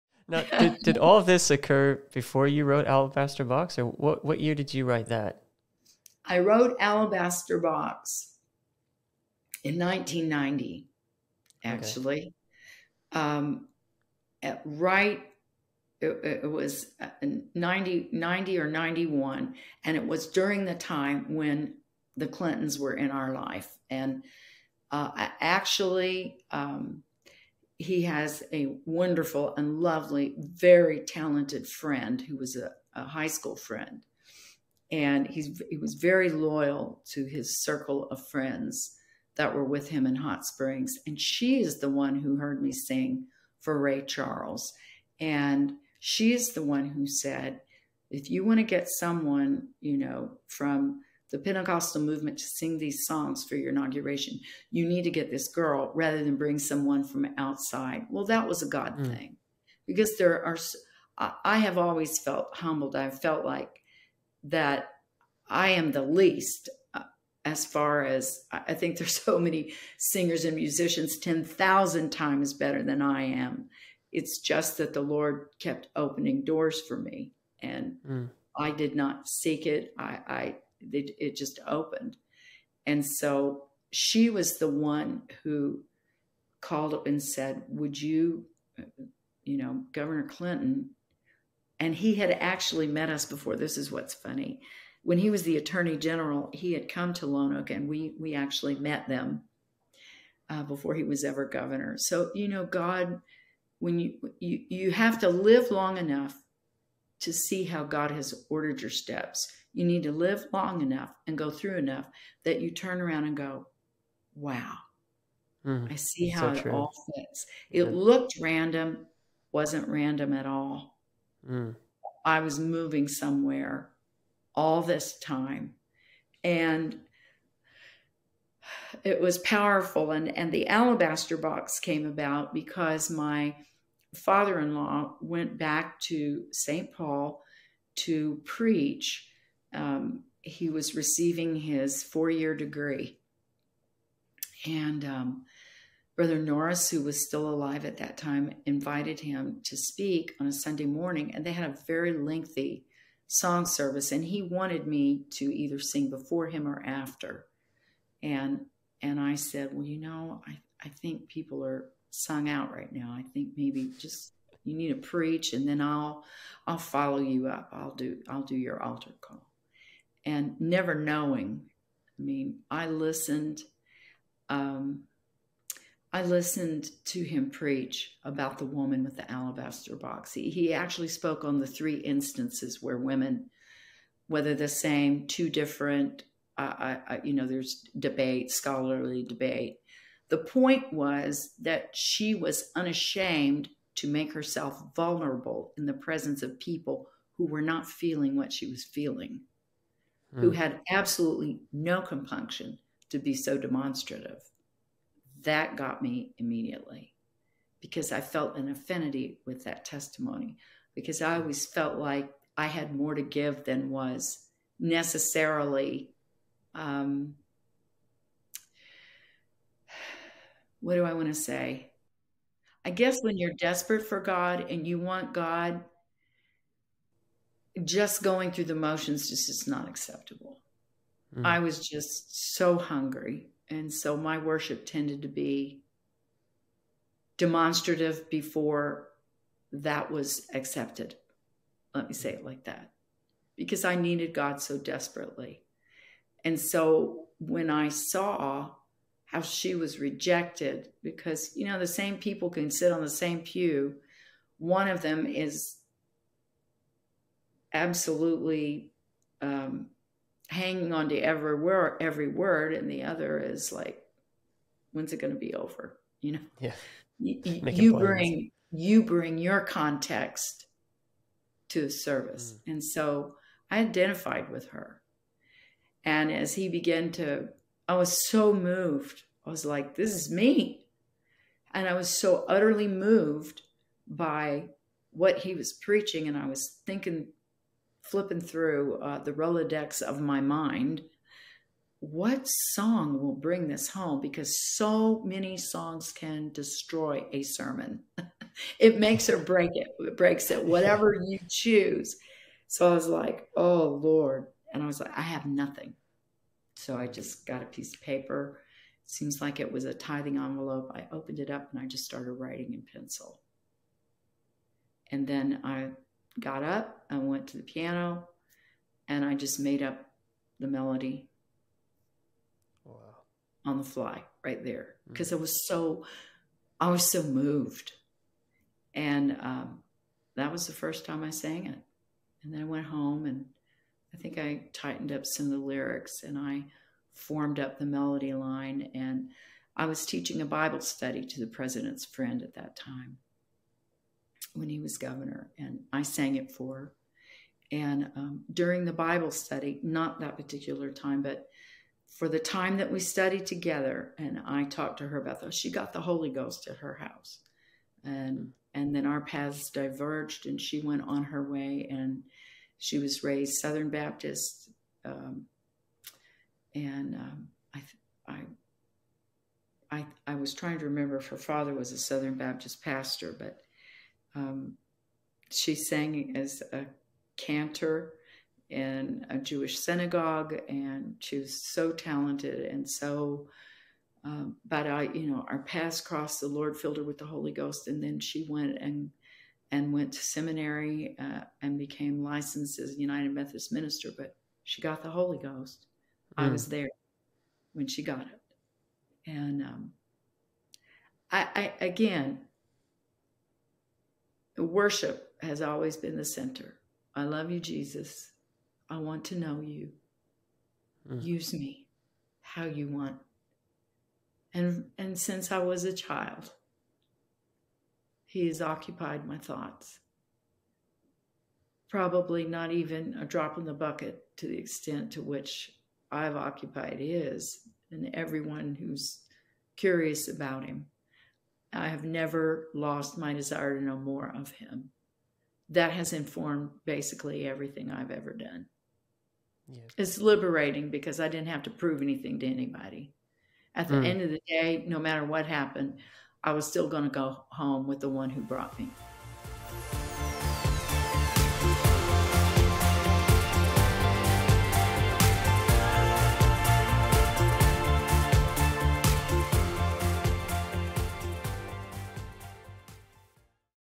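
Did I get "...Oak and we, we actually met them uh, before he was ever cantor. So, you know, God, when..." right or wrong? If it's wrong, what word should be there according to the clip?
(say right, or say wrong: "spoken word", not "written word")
wrong: "governor", not "cantor".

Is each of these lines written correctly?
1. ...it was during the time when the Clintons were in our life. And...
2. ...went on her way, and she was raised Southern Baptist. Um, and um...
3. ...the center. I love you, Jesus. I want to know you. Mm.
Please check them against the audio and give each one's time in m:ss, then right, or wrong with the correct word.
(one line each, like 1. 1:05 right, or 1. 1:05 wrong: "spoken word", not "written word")
1. 0:19 right
2. 6:00 right
3. 6:46 right.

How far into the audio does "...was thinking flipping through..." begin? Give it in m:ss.
4:46.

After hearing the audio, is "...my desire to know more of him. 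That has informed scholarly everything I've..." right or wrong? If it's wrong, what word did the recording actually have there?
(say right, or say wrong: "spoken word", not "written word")
wrong: "basically", not "scholarly".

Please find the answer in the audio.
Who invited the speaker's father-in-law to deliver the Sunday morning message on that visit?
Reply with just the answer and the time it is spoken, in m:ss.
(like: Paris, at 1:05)
Brother Norris, at 2:26.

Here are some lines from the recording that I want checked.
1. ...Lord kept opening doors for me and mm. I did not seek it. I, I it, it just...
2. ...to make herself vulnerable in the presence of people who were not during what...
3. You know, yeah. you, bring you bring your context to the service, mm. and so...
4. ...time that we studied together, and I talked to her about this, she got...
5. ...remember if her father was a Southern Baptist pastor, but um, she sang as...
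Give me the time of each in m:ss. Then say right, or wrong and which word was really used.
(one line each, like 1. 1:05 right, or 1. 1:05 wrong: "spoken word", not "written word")
1. 1:15 right
2. 3:13 wrong: "feeling", not "during"
3. 4:26 right
4. 5:52 right
5. 6:10 right.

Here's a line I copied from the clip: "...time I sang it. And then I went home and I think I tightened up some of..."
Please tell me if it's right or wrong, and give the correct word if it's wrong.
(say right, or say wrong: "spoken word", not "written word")
right.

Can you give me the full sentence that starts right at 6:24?
Um, but I, you know, our paths crossed.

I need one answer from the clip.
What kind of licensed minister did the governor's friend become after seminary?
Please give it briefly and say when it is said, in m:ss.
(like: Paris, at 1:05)
United Methodist minister, at 6:32.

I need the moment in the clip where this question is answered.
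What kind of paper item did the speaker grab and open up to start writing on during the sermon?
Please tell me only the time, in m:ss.
5:09.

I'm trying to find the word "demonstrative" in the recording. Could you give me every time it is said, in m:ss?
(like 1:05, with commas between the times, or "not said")
3:23, 3:57.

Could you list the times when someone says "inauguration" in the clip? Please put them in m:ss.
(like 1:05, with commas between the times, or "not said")
0:53.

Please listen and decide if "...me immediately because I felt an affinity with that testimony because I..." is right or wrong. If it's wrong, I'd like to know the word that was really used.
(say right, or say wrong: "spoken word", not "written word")
right.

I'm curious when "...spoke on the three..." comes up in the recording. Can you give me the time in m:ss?
3:01.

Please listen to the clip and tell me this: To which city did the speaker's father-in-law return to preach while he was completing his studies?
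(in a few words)
St. Paul.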